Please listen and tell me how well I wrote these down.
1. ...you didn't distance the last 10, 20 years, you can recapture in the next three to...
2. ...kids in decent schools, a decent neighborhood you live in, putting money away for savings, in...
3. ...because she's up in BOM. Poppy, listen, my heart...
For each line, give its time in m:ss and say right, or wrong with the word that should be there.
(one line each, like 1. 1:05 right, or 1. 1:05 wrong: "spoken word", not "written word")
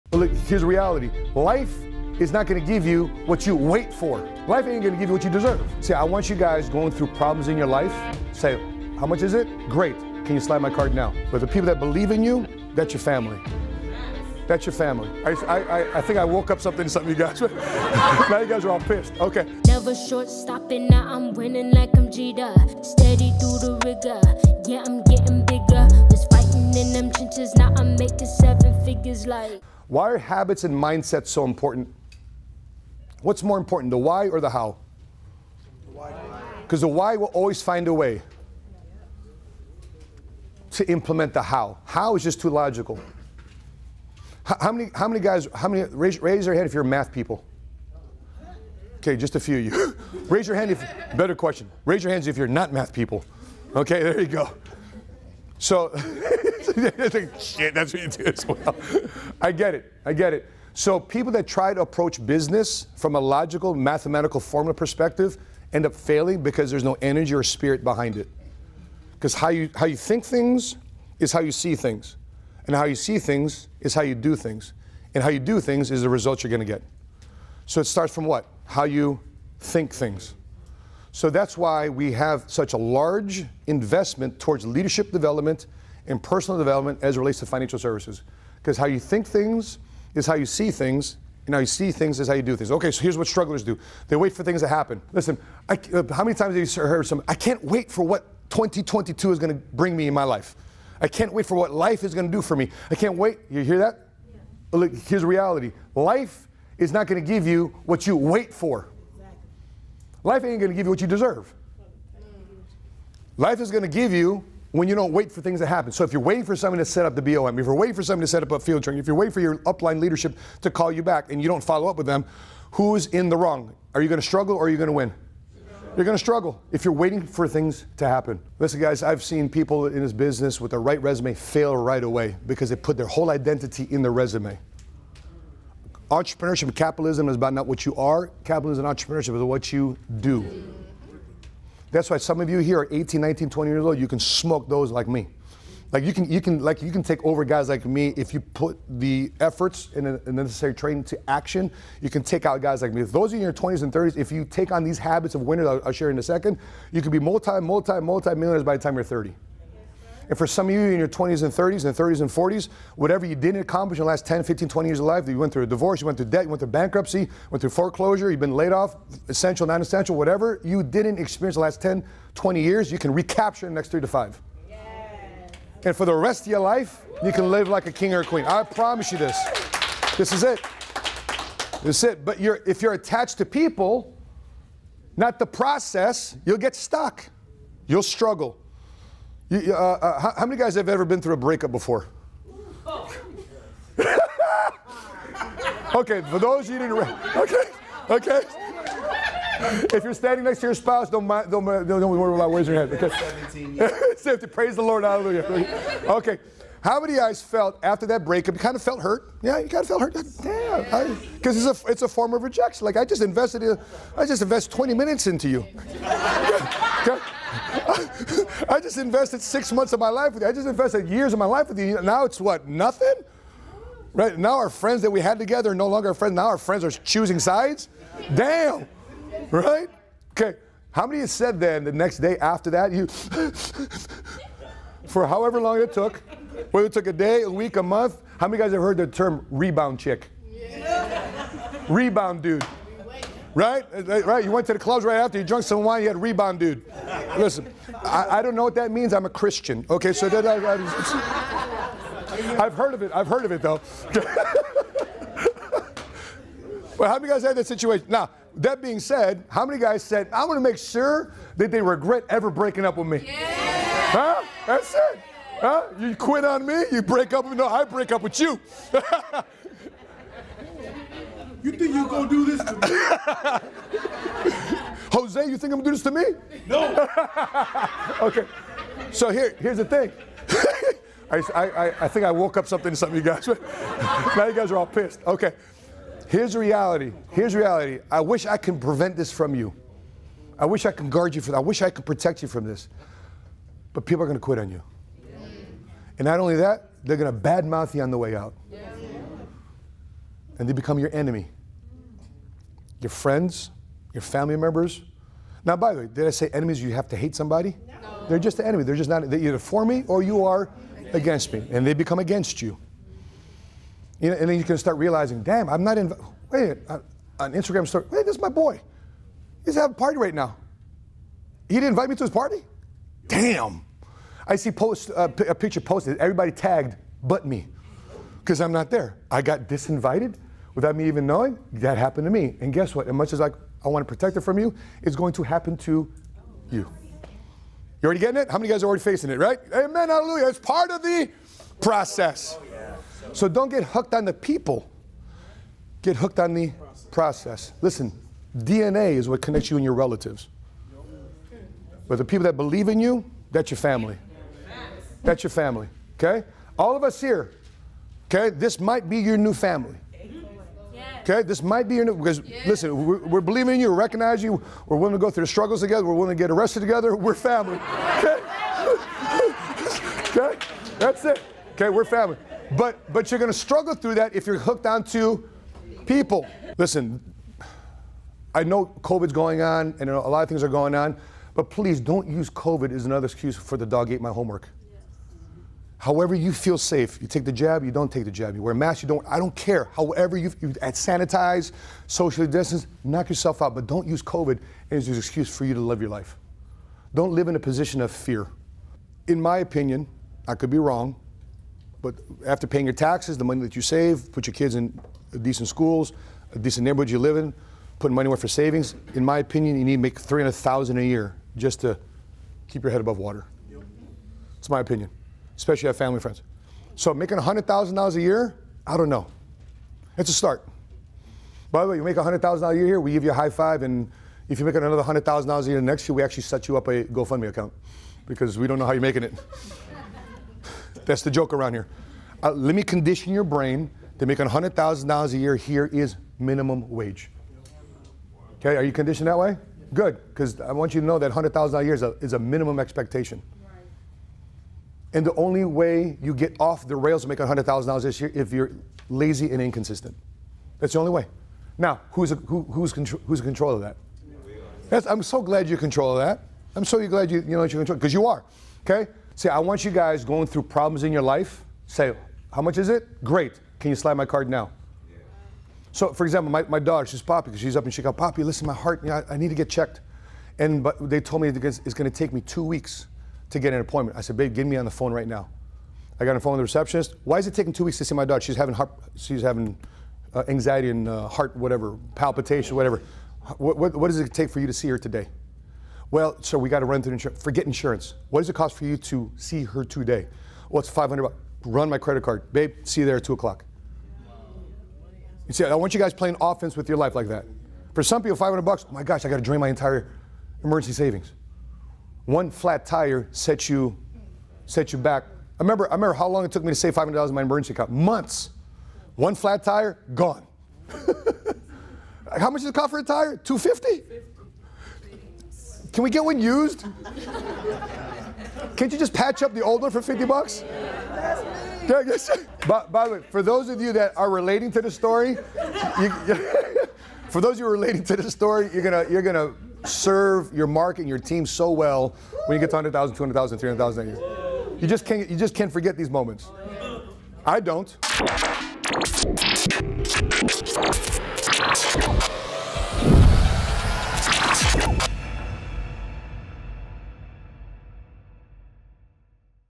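1. 2:50 wrong: "experience", not "distance"
2. 6:44 right
3. 7:47 wrong: "Chicago", not "BOM".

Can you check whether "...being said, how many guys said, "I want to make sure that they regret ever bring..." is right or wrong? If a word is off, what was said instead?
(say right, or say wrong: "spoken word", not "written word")
wrong: "breaking", not "bring".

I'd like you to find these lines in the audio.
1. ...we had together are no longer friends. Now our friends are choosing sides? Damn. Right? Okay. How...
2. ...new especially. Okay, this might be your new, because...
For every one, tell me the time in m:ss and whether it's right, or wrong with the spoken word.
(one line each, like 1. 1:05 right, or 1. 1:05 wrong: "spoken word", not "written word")
1. 3:45 right
2. 5:59 wrong: "family", not "especially".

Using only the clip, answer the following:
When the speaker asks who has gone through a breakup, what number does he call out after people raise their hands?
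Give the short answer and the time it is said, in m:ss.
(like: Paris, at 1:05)
17, at 3:24.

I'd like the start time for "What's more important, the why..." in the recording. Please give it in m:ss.
0:33.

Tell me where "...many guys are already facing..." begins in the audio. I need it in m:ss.
5:38.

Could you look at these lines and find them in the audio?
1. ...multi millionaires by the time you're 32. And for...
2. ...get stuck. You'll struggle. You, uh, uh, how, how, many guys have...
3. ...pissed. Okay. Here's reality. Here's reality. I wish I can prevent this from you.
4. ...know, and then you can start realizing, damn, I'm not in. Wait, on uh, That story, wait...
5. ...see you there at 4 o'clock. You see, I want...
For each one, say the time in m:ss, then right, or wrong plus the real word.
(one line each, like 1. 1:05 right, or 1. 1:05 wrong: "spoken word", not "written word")
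1. 2:37 wrong: "30", not "32"
2. 3:06 right
3. 4:44 right
4. 5:14 wrong: "Instagram", not "That"
5. 8:12 wrong: "2", not "4".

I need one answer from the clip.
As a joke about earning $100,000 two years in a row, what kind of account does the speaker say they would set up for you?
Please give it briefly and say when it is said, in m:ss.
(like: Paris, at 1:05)
GoFundMe, at 7:07.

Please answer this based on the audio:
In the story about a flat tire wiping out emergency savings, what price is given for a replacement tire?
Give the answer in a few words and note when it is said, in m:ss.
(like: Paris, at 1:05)
250, at 8:33.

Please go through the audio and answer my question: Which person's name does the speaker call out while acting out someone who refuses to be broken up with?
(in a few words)
Jose.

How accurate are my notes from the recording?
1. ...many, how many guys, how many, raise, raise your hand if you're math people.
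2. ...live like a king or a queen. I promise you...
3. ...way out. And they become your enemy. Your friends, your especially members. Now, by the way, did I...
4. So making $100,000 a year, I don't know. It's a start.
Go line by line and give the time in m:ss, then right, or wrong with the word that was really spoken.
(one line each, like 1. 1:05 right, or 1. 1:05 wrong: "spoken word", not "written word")
1. 0:44 right
2. 2:57 right
3. 4:58 wrong: "family", not "especially"
4. 6:56 right.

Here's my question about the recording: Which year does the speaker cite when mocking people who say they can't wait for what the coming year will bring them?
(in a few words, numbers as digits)
2022.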